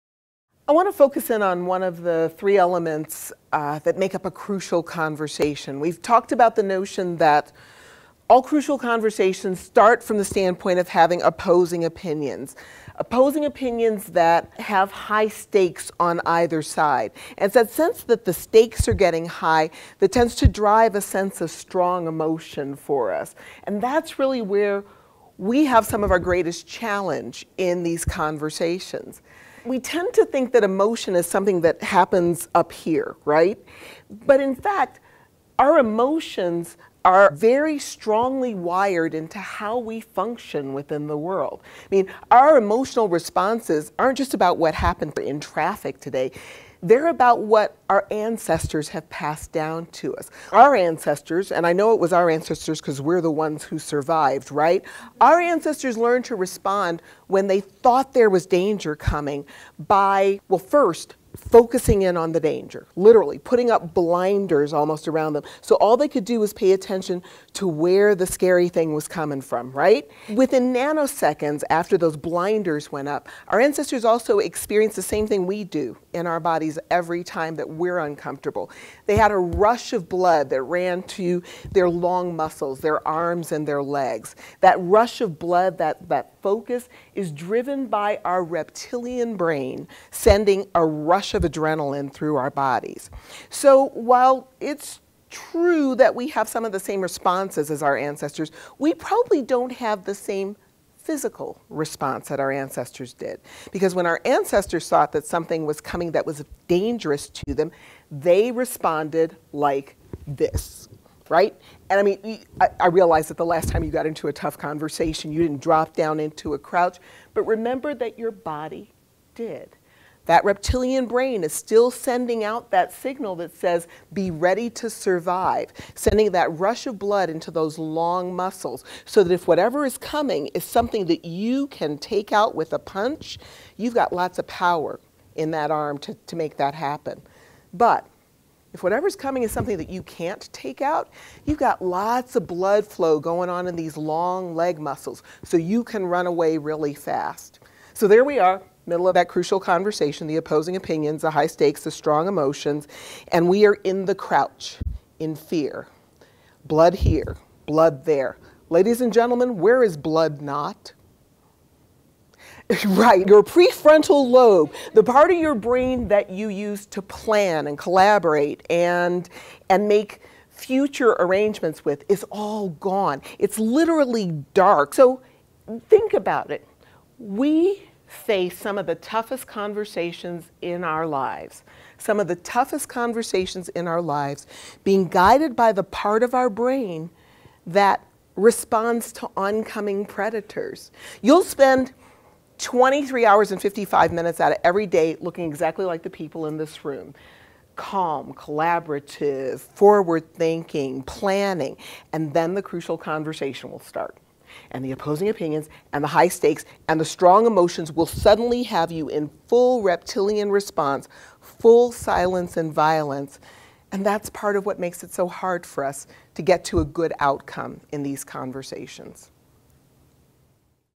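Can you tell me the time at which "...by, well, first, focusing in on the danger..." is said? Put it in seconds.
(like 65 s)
59 s.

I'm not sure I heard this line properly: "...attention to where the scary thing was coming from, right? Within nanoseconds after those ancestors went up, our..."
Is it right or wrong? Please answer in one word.
wrong.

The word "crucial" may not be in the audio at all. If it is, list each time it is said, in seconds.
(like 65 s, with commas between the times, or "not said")
4 s, 8 s, 149 s, 202 s.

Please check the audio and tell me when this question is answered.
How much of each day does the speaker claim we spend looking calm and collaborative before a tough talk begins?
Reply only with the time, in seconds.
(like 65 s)
192 s.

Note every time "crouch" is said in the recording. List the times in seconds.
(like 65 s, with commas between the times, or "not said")
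116 s, 154 s.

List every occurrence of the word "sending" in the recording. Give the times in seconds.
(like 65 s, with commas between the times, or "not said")
90 s, 121 s, 125 s.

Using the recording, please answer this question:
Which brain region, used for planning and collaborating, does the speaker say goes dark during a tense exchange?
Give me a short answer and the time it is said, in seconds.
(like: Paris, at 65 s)
prefrontal lobe, at 163 s.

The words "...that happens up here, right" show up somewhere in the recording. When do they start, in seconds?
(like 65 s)
31 s.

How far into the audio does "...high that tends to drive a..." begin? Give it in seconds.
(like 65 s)
19 s.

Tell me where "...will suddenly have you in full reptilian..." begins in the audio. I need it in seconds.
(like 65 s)
207 s.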